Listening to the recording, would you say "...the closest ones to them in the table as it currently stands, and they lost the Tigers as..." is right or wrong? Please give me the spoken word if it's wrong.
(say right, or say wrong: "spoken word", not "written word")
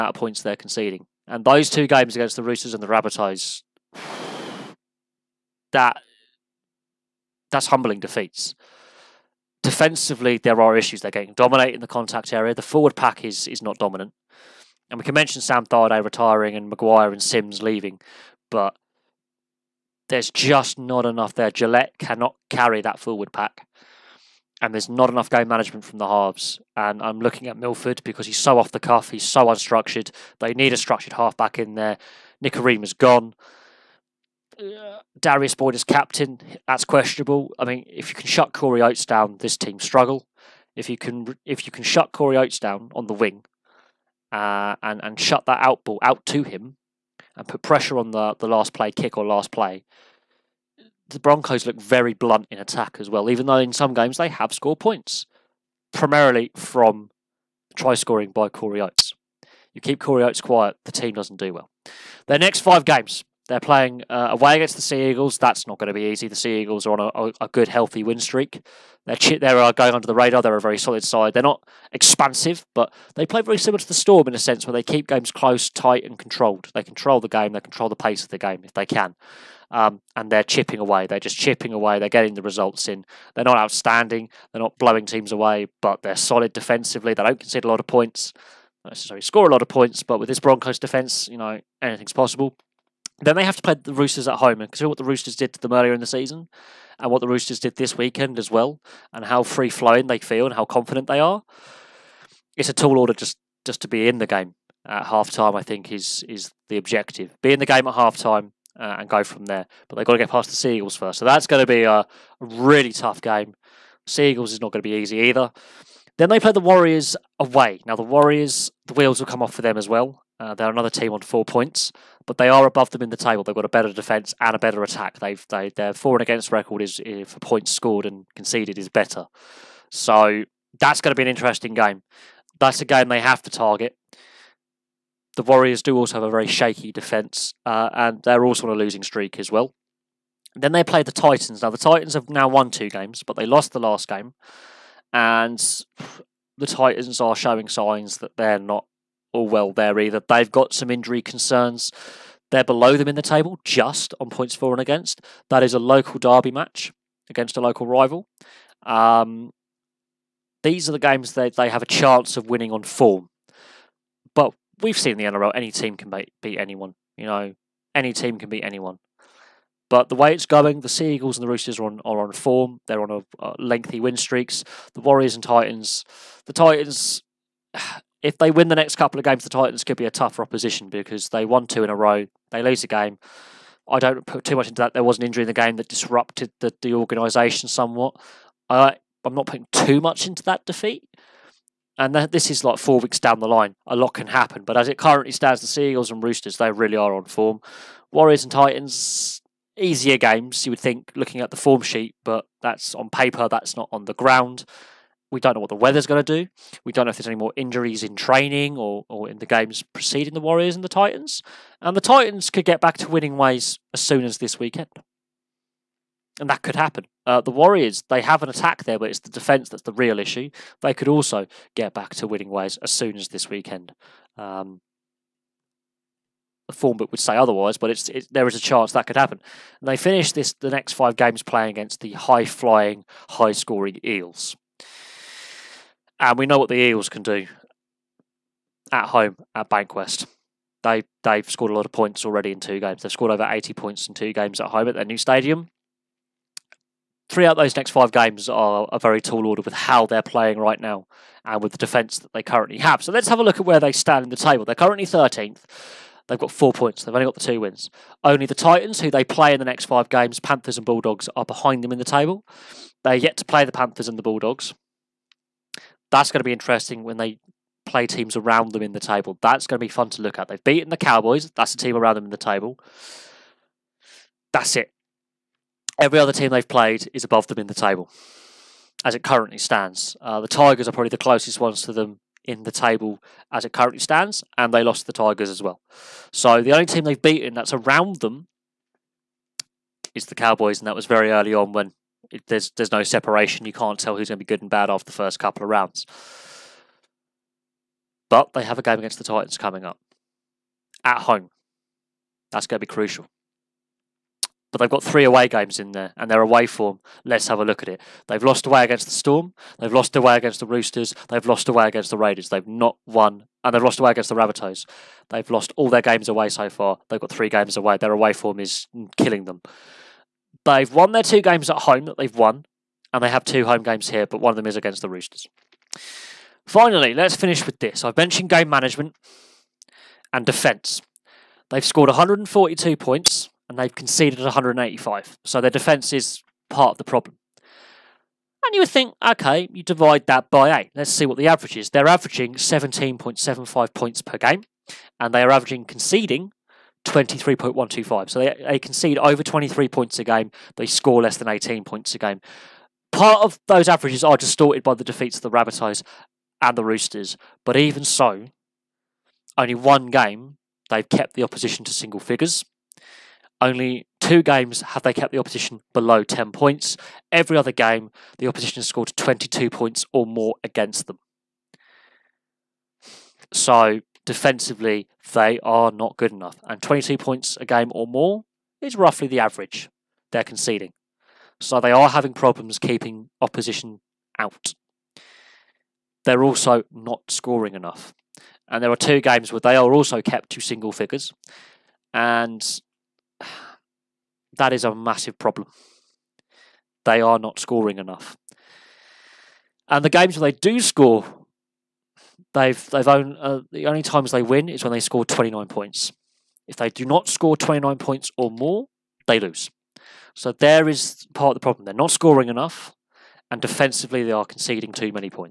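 right.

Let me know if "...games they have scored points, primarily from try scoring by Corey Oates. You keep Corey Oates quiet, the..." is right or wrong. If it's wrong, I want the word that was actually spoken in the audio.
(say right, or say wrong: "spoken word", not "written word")
right.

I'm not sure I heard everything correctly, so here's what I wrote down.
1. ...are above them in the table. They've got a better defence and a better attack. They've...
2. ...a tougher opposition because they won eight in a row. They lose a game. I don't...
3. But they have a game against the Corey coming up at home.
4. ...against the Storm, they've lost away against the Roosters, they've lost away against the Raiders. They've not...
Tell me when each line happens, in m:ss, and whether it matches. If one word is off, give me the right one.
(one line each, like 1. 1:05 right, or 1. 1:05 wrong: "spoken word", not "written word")
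1. 2:02 right
2. 3:00 wrong: "two", not "eight"
3. 4:58 wrong: "Titans", not "Corey"
4. 5:08 right.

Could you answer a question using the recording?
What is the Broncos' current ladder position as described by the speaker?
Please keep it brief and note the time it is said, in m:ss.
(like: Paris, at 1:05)
13th, at 4:15.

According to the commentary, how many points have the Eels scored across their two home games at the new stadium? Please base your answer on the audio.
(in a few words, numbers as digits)
over 80.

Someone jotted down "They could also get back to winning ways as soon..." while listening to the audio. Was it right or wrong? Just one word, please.
right.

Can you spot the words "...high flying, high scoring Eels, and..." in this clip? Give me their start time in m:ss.
3:52.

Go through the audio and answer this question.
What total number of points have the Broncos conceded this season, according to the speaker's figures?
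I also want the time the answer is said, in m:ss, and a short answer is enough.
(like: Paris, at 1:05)
185, at 5:34.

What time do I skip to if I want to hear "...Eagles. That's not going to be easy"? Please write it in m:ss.
1:05.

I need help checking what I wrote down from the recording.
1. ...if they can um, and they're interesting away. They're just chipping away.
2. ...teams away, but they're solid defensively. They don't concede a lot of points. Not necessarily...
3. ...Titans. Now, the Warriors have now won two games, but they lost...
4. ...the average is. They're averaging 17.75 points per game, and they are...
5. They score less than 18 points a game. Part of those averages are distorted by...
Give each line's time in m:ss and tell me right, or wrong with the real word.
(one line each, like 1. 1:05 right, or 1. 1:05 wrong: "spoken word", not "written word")
1. 1:18 wrong: "chipping", not "interesting"
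2. 1:25 right
3. 2:21 wrong: "Titans", not "Warriors"
4. 5:41 right
5. 5:50 right.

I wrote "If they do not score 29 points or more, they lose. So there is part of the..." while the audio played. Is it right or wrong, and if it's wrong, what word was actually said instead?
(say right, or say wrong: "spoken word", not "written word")
right.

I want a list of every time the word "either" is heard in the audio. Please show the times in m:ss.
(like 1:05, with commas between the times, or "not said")
1:55, 2:29.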